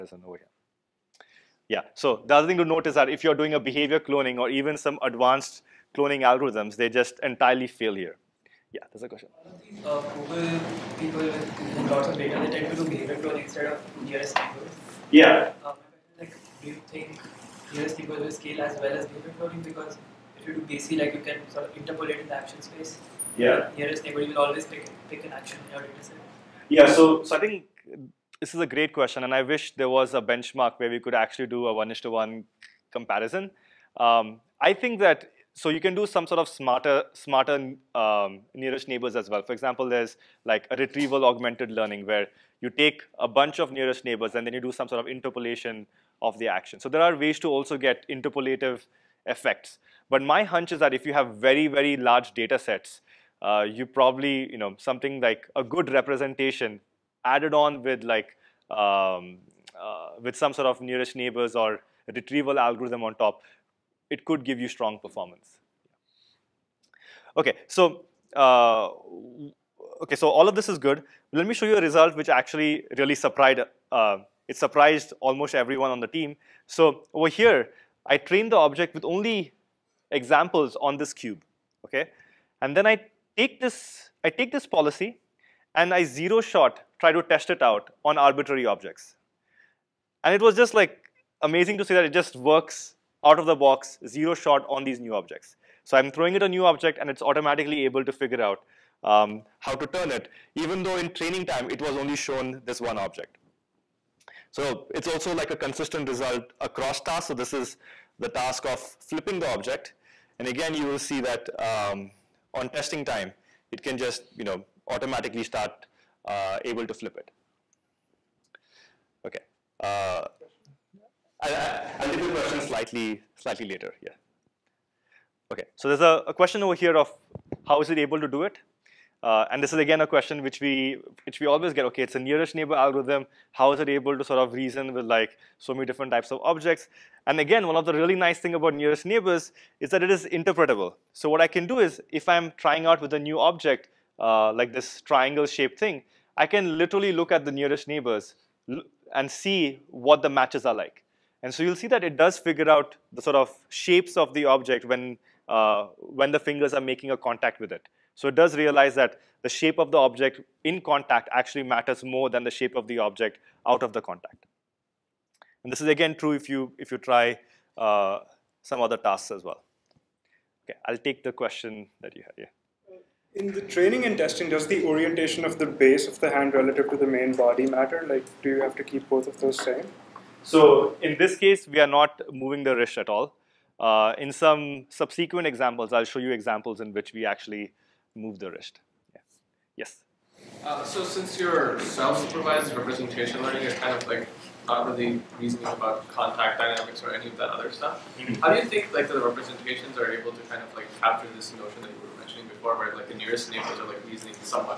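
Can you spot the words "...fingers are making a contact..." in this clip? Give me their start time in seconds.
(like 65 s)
156 s.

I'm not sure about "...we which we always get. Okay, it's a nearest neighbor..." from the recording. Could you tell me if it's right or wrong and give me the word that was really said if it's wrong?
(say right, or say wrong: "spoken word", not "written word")
right.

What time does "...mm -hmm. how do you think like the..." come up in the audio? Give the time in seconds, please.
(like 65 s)
198 s.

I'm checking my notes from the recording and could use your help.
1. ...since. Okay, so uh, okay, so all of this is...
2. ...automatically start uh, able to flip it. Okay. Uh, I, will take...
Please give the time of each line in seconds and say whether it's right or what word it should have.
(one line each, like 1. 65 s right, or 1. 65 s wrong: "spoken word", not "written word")
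1. 64 s wrong: "performance", not "since"
2. 114 s right.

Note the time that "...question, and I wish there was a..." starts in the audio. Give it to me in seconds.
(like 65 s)
28 s.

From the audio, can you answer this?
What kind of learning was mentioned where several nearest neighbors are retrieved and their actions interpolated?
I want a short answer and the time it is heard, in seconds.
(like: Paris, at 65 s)
retrieval augmented learning, at 40 s.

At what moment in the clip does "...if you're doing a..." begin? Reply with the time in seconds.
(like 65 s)
3 s.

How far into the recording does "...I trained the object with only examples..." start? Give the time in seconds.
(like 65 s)
78 s.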